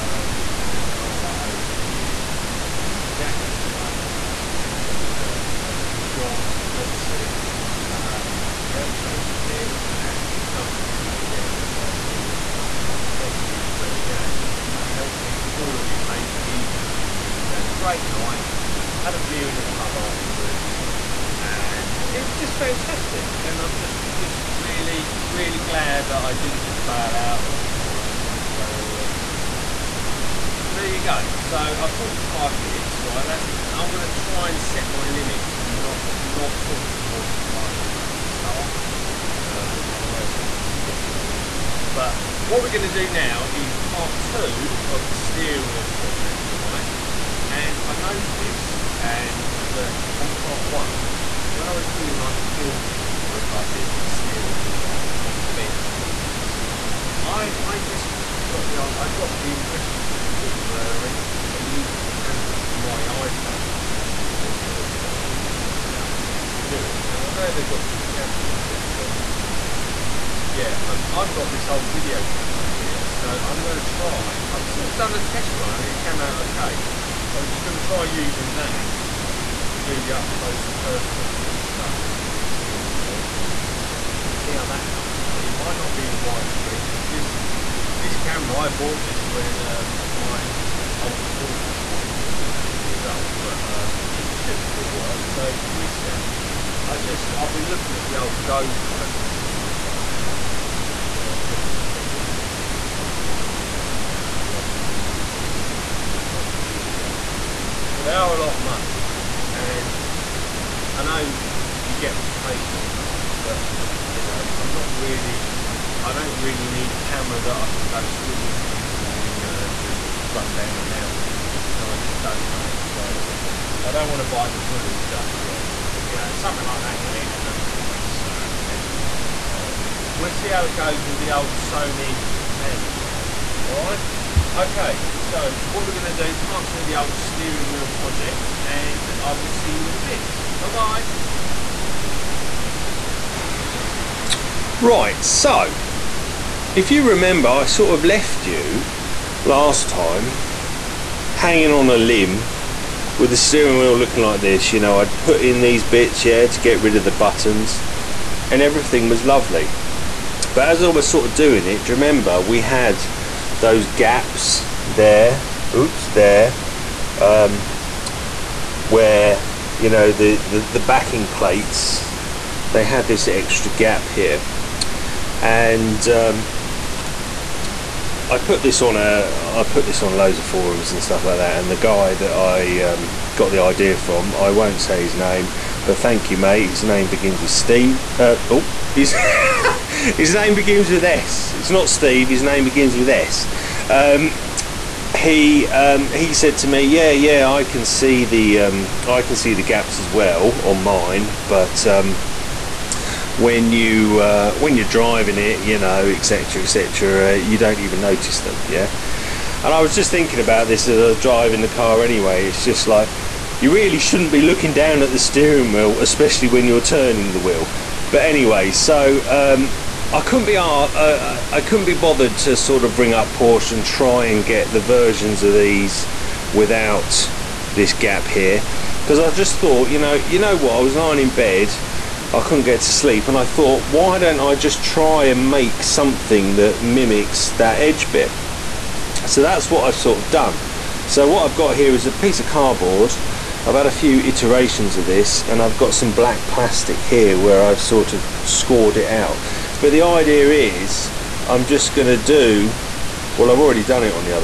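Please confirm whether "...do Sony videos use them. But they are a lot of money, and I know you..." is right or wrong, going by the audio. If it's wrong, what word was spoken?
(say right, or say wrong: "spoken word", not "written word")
wrong: "YouTube", not "Sony".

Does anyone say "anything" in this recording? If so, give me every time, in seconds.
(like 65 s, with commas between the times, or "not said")
27 s.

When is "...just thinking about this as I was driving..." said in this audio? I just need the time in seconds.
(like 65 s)
209 s.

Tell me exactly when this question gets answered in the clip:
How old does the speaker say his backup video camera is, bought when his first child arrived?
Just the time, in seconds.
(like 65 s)
92 s.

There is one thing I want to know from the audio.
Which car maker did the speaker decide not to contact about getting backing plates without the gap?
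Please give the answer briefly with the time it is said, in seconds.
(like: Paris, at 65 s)
Porsche, at 223 s.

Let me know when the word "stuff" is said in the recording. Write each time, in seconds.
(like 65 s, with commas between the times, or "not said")
81 s, 99 s, 181 s.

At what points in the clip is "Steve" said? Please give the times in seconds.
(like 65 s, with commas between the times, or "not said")
187 s, 191 s.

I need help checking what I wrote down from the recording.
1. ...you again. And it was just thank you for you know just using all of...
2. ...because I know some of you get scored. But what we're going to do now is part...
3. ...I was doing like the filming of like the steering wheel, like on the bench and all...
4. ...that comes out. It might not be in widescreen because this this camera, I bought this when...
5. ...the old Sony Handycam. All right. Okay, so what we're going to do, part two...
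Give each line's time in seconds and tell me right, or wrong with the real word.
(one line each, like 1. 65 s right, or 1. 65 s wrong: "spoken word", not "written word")
1. 11 s wrong: "helping", not "using"
2. 39 s wrong: "bored", not "scored"
3. 51 s right
4. 84 s right
5. 131 s right.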